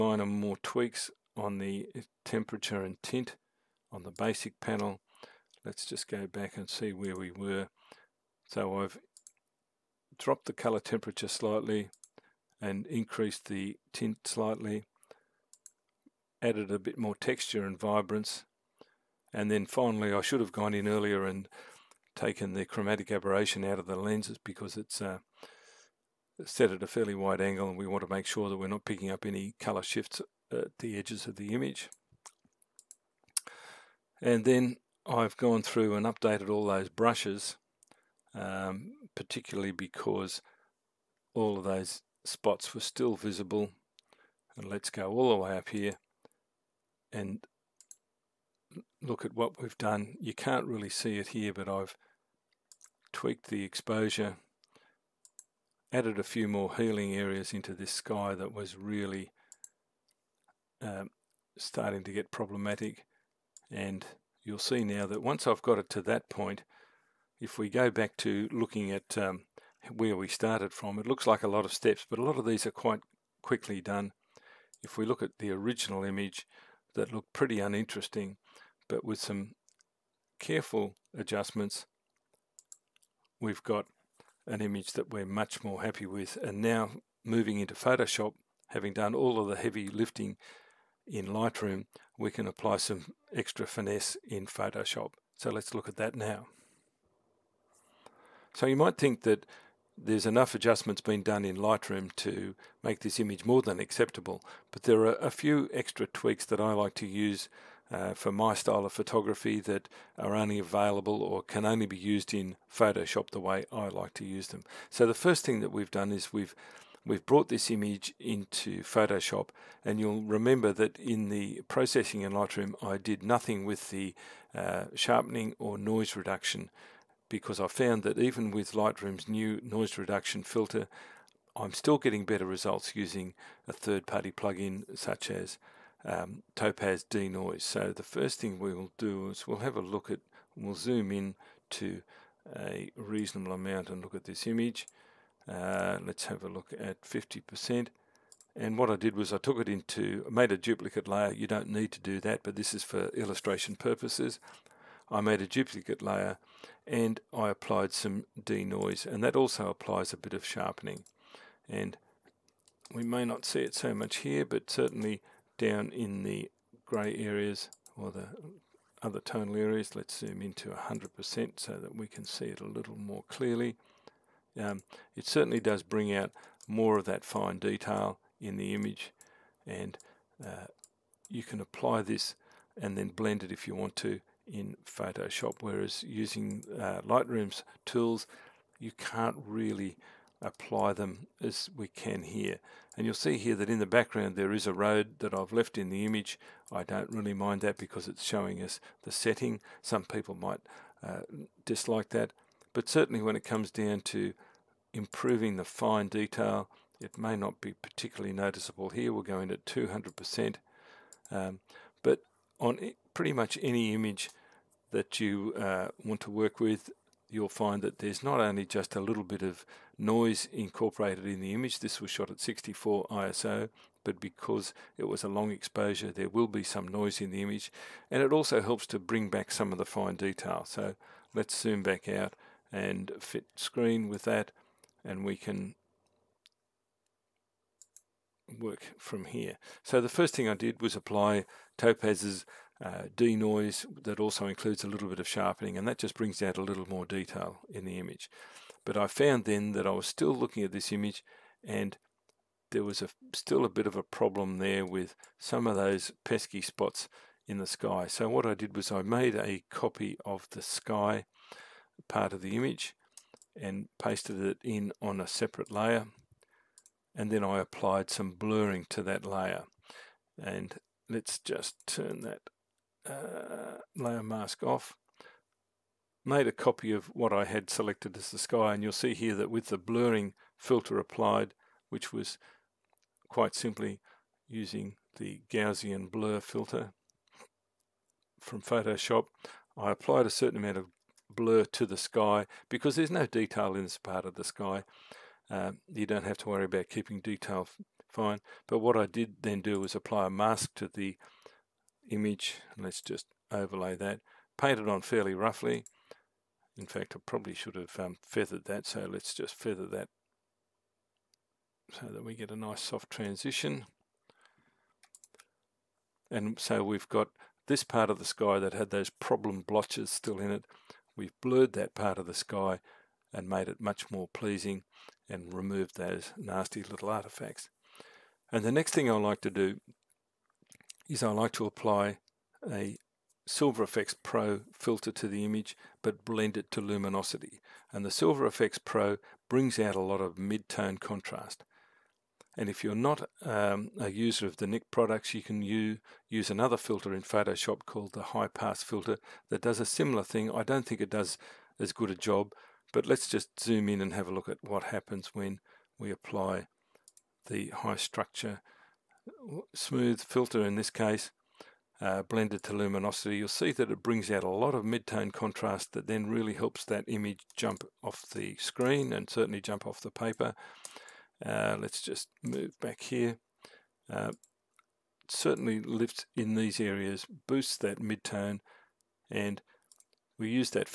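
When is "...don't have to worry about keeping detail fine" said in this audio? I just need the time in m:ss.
4:56.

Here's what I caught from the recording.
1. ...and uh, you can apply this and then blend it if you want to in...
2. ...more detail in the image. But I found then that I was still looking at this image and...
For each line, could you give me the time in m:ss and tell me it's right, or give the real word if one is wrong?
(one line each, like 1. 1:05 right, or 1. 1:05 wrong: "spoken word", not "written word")
1. 2:59 right
2. 4:06 right.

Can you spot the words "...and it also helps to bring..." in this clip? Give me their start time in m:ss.
3:48.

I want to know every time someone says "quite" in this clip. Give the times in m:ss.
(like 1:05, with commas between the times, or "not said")
1:12, 4:43.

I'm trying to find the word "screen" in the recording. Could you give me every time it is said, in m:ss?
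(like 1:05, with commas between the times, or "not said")
3:53, 6:08.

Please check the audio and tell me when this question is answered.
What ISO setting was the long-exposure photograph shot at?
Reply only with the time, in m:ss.
3:42.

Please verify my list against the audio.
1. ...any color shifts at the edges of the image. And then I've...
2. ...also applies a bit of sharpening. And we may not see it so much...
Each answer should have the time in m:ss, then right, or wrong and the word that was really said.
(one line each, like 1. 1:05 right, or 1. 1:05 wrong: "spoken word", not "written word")
1. 0:29 right
2. 2:39 right.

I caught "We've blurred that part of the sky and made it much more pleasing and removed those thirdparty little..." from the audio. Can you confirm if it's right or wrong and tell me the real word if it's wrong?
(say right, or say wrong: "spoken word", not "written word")
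wrong: "nasty", not "thirdparty".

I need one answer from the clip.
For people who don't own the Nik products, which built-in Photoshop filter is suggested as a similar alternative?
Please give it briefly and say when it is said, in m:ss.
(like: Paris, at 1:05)
High pass filter, at 5:48.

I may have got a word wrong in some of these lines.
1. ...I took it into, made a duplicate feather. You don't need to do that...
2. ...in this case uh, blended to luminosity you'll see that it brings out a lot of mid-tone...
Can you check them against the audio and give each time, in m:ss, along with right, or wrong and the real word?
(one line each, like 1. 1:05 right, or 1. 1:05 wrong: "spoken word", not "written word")
1. 2:29 wrong: "layer", not "feather"
2. 6:00 right.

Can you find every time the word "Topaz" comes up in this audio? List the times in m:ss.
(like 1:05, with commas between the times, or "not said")
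2:16, 4:01.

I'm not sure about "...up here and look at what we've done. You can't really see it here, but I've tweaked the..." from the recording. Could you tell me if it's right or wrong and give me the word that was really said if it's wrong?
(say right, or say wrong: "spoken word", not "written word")
right.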